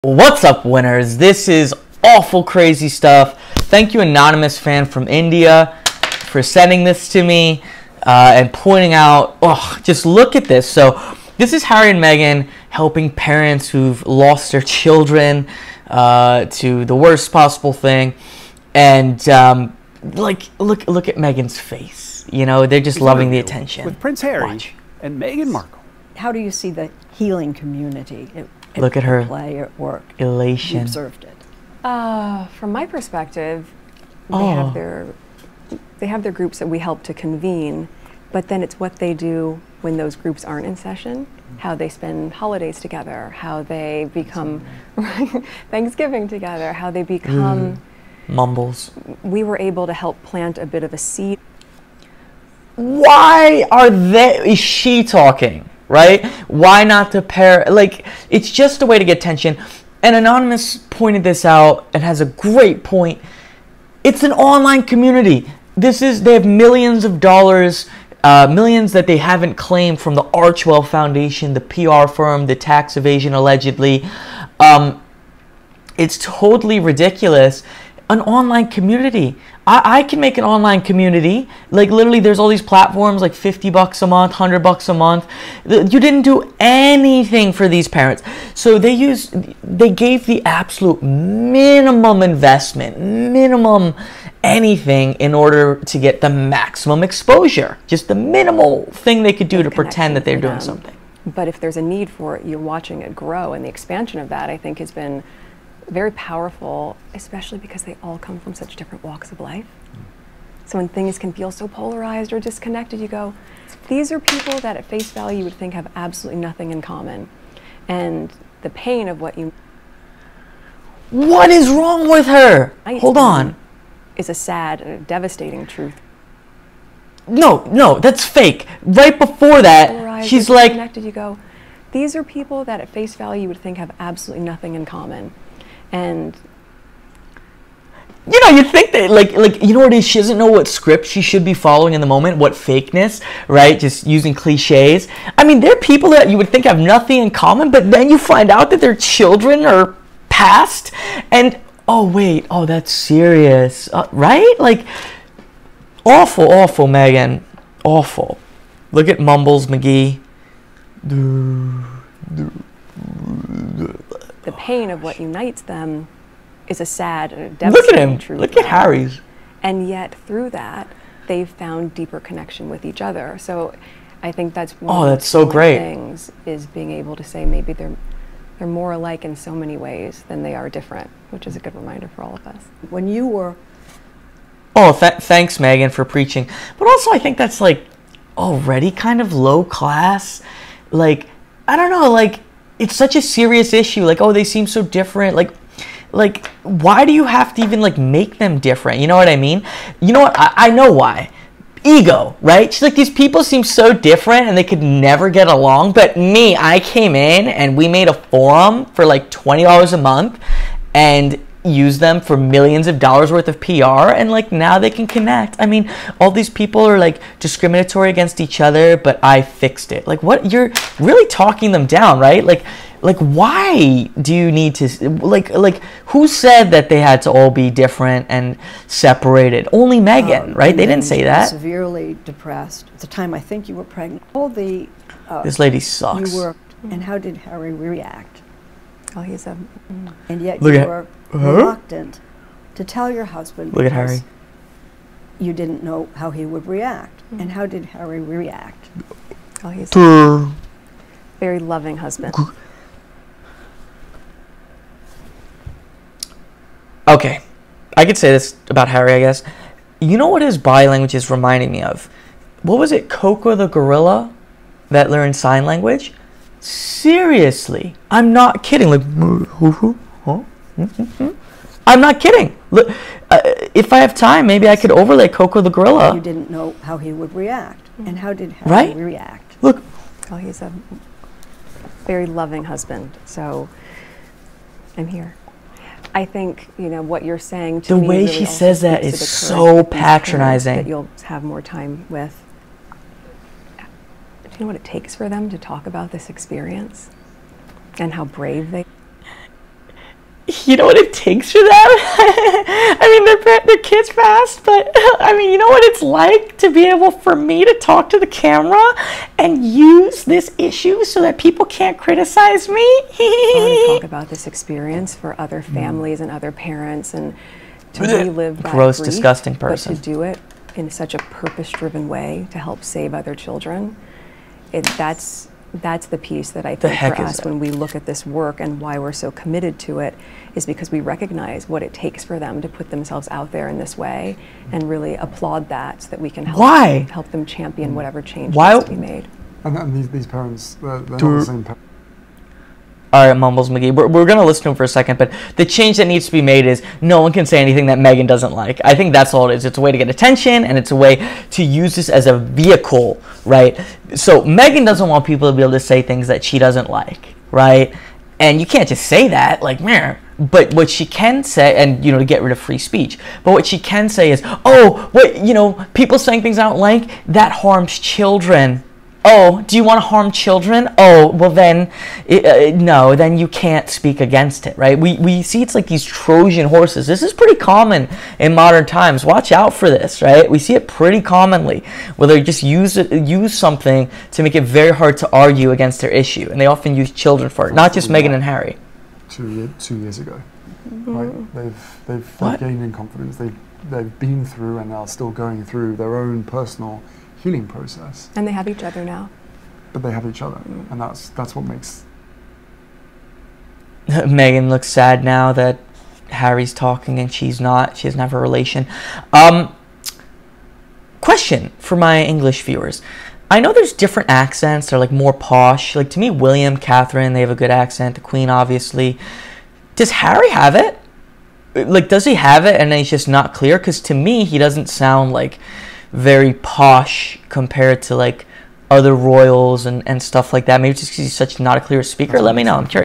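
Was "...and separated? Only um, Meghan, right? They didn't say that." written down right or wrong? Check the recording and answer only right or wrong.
right.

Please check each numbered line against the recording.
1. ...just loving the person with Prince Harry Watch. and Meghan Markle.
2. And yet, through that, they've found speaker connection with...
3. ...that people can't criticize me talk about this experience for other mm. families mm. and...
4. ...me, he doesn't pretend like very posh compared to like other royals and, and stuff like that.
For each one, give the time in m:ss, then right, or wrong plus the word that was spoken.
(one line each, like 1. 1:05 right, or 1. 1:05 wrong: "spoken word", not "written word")
1. 0:22 wrong: "attention", not "person"
2. 2:49 wrong: "deeper", not "speaker"
3. 5:11 right
4. 7:04 wrong: "sound", not "pretend".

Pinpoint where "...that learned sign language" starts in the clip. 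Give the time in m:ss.
4:24.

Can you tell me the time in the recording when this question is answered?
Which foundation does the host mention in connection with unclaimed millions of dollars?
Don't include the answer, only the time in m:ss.
1:10.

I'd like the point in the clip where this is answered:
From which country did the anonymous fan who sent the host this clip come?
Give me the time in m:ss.
0:05.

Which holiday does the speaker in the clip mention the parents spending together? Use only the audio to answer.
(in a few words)
Thanksgiving.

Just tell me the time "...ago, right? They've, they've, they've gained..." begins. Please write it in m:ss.
6:30.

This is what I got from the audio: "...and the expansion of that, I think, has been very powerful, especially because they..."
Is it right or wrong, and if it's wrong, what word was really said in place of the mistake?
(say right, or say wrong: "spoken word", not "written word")
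right.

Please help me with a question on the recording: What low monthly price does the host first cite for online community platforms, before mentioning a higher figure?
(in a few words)
$50.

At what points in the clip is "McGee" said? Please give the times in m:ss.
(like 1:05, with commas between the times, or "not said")
2:39, 5:43.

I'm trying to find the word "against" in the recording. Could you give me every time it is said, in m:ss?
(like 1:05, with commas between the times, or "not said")
3:38, 6:14, 6:25.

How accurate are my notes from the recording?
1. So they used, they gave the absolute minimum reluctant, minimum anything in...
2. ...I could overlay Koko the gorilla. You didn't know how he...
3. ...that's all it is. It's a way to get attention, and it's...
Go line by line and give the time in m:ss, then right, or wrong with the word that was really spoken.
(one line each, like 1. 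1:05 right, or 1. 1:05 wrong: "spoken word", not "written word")
1. 1:28 wrong: "investment", not "reluctant"
2. 4:34 right
3. 5:49 right.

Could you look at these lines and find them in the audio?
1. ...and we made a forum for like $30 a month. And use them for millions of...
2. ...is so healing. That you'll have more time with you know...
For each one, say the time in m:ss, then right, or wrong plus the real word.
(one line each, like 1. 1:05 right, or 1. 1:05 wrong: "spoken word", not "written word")
1. 3:27 wrong: "20", not "30"
2. 4:49 wrong: "patronizing", not "healing".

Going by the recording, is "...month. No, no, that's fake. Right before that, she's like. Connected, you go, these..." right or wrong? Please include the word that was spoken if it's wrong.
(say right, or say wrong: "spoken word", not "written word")
wrong: "truth", not "month".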